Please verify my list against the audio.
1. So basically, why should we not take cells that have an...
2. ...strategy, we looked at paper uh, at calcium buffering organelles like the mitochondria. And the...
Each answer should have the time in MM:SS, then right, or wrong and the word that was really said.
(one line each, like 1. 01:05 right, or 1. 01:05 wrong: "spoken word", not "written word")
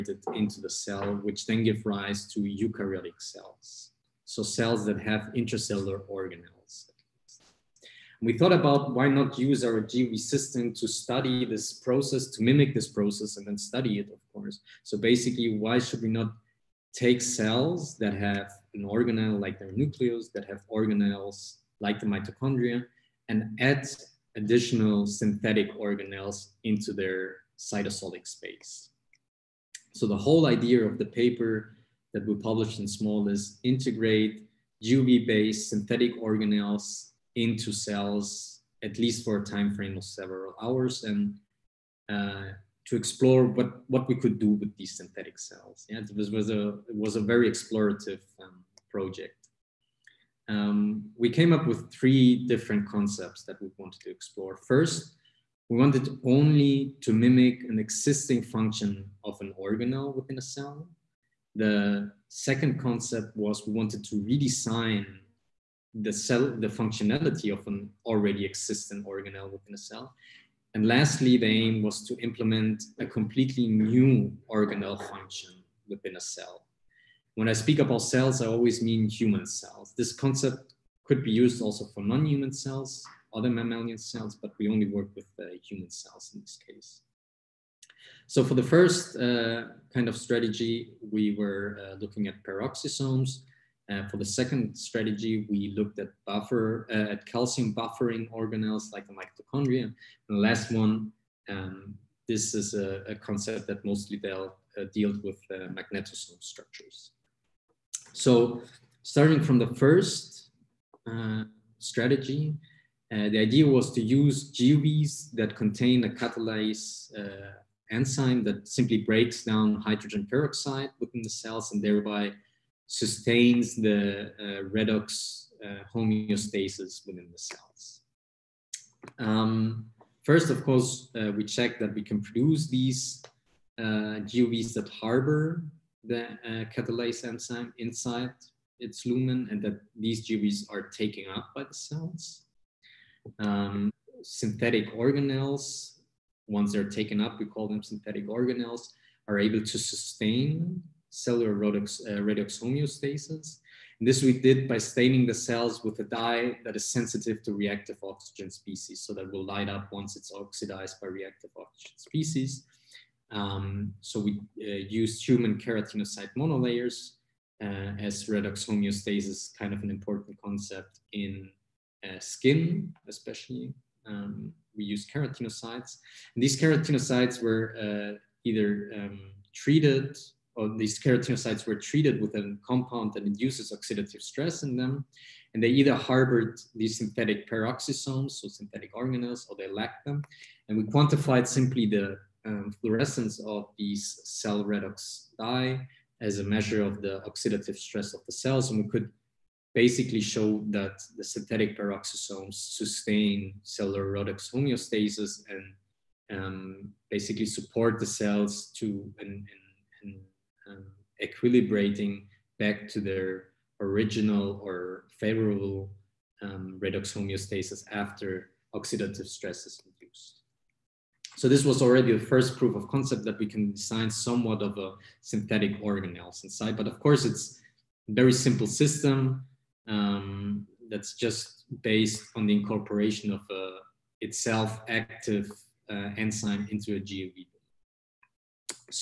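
1. 00:14 right
2. 01:34 wrong: "buffer", not "paper".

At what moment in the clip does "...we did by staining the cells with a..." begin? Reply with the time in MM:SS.
02:34.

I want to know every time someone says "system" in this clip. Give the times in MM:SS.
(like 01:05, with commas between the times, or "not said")
00:10, 03:48.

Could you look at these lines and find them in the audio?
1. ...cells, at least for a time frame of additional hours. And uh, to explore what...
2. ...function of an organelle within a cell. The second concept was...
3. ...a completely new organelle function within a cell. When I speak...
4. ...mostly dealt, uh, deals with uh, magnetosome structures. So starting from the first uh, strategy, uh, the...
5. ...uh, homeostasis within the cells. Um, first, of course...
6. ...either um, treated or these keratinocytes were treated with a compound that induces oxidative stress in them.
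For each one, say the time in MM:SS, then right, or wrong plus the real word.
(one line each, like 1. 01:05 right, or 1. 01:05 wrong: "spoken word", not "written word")
1. 00:37 wrong: "several", not "additional"
2. 00:58 right
3. 01:12 right
4. 01:43 right
5. 02:05 right
6. 02:58 right.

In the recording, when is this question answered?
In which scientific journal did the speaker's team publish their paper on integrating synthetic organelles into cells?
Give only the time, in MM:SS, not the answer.
00:32.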